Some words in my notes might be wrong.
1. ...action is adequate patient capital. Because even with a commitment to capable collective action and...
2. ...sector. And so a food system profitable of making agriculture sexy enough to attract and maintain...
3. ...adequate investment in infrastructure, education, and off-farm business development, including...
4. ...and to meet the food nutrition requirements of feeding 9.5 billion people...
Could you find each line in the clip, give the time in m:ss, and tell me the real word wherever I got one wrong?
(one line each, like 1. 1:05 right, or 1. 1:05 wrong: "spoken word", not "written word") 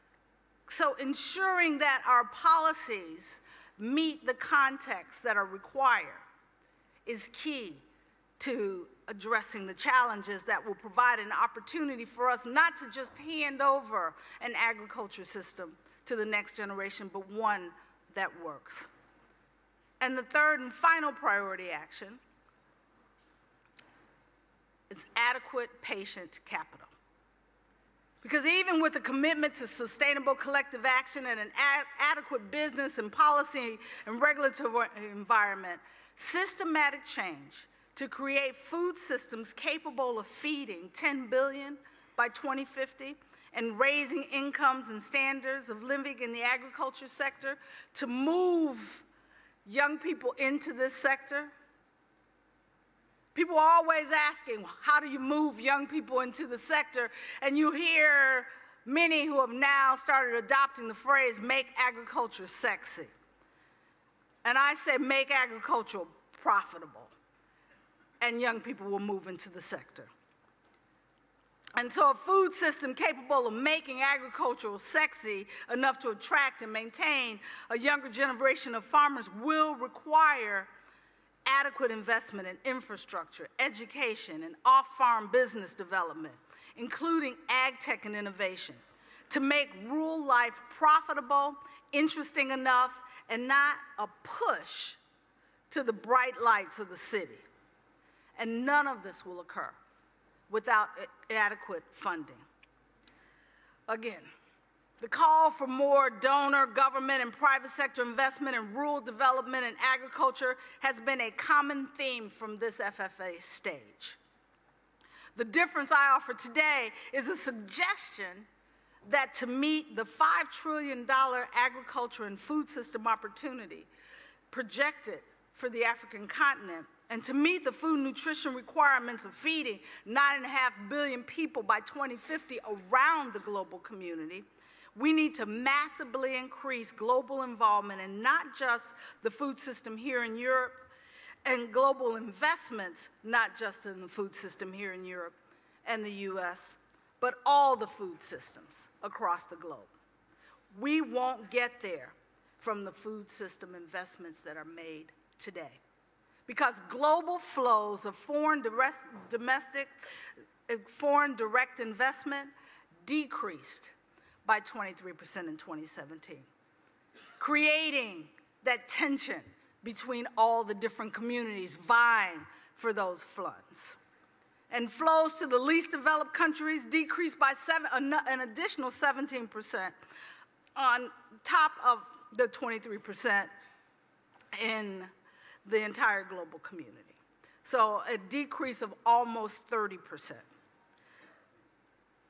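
1. 0:21 wrong: "sustainable", not "capable"
2. 1:09 wrong: "capable", not "profitable"
3. 1:21 right
4. 2:07 right.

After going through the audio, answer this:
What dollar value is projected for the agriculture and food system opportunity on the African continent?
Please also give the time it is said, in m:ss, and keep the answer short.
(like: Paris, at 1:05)
$5 trillion, at 2:00.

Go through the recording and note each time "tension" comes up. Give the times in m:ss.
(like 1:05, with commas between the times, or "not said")
2:48.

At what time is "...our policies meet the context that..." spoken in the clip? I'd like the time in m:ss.
0:02.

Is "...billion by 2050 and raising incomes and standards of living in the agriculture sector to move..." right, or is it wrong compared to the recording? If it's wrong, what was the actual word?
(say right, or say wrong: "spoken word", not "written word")
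right.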